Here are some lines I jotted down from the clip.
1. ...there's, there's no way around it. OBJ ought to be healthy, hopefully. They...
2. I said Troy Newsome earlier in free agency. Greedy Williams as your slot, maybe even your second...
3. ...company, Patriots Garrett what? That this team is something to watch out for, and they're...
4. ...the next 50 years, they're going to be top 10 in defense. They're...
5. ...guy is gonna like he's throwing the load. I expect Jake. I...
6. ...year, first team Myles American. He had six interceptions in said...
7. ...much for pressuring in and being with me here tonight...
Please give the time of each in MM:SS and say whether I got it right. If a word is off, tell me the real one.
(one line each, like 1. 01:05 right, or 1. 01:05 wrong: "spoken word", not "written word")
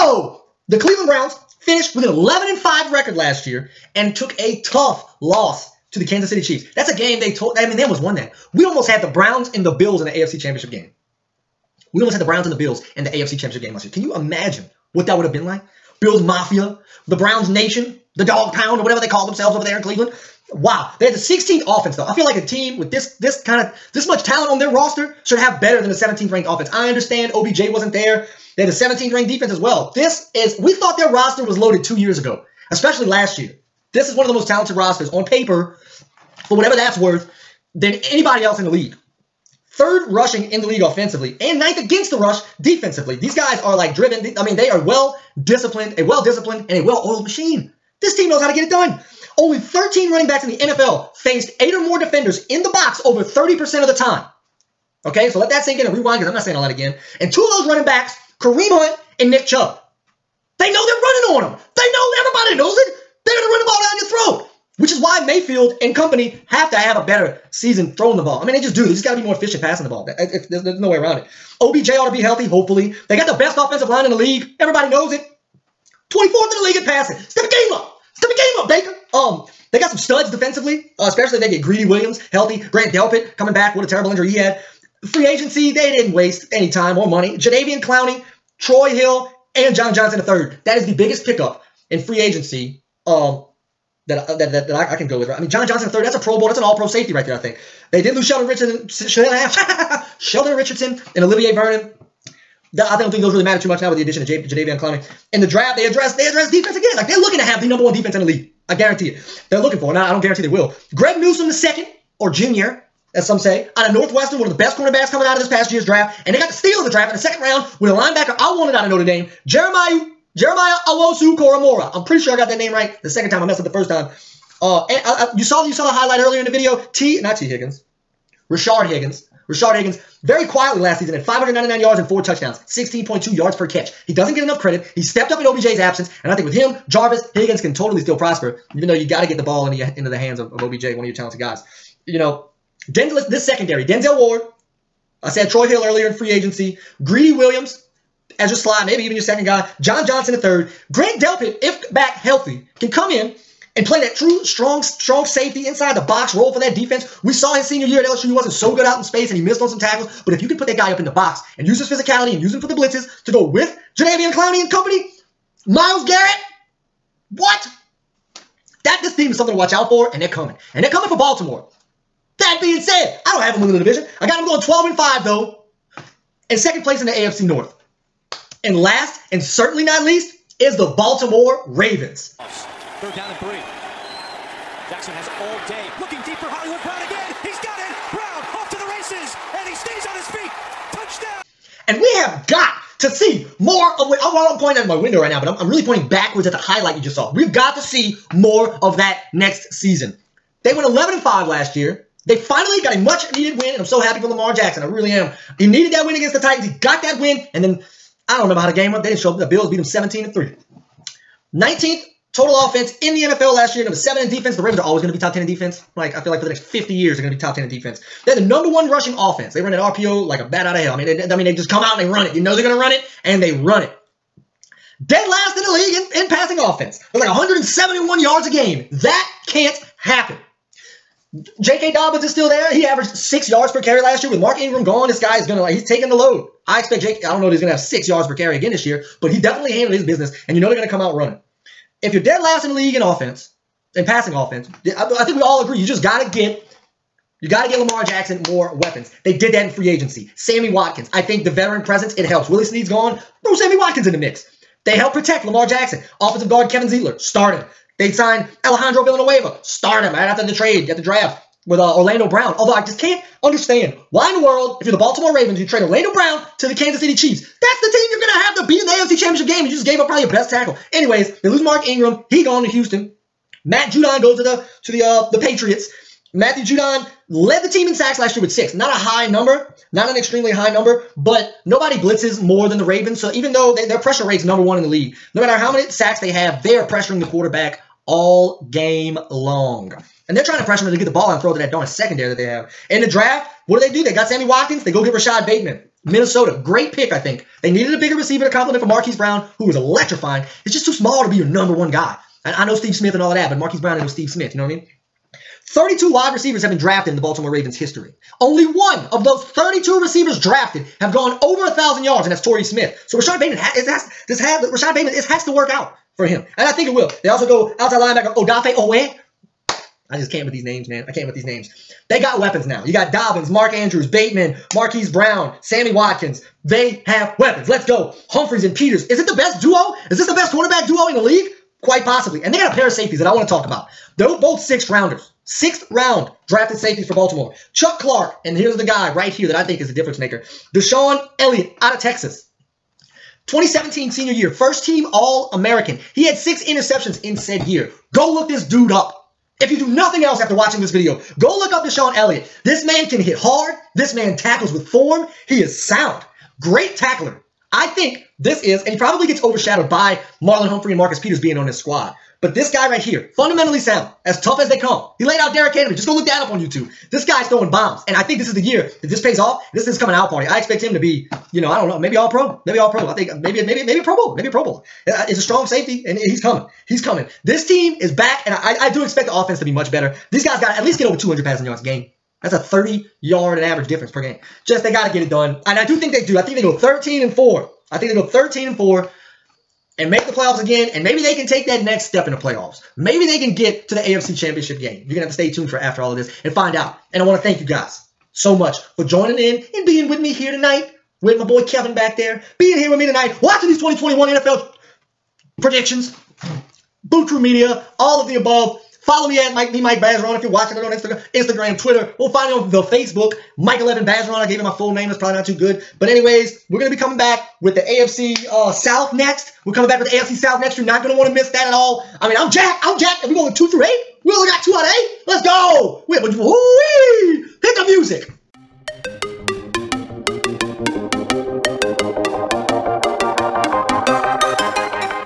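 1. 01:10 right
2. 02:25 wrong: "Hill", not "Newsome"
3. 02:44 wrong: "Myles", not "Patriots"
4. 03:36 right
5. 03:55 wrong: "taking", not "throwing"
6. 05:44 wrong: "All", not "Myles"
7. 06:38 wrong: "joining", not "pressuring".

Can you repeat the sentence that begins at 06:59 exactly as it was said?
We're coming back with the AFC South next.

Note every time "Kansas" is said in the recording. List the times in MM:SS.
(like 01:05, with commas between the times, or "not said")
00:06, 04:26.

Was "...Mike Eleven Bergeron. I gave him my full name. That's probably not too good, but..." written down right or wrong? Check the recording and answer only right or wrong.
right.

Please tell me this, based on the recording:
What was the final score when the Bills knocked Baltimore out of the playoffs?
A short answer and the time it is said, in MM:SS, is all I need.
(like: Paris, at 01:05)
17 to 3, at 03:29.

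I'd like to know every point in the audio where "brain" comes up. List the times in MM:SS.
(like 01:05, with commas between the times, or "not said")
not said.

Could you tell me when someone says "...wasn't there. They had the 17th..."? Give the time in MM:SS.
00:27.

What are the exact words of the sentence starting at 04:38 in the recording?
Not a high number, not an extremely high number, but nobody blitzes more than the Ravens.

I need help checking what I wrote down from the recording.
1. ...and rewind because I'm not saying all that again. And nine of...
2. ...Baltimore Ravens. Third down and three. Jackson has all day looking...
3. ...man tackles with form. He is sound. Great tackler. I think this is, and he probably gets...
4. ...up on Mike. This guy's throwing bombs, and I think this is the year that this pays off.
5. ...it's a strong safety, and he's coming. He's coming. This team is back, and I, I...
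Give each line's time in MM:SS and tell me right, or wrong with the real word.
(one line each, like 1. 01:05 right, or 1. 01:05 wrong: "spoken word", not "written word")
1. 00:55 wrong: "two", not "nine"
2. 03:00 right
3. 05:54 right
4. 06:06 wrong: "YouTube", not "Mike"
5. 06:15 right.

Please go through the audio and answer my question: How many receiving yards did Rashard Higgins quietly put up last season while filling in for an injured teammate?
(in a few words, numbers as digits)
599.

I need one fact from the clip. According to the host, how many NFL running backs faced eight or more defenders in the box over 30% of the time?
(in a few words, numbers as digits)
13.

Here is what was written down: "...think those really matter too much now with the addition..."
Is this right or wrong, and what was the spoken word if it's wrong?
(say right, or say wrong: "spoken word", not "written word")
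right.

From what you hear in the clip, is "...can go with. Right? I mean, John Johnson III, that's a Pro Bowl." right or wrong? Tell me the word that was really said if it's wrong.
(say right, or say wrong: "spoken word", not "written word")
right.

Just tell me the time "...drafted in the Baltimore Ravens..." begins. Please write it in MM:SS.
05:06.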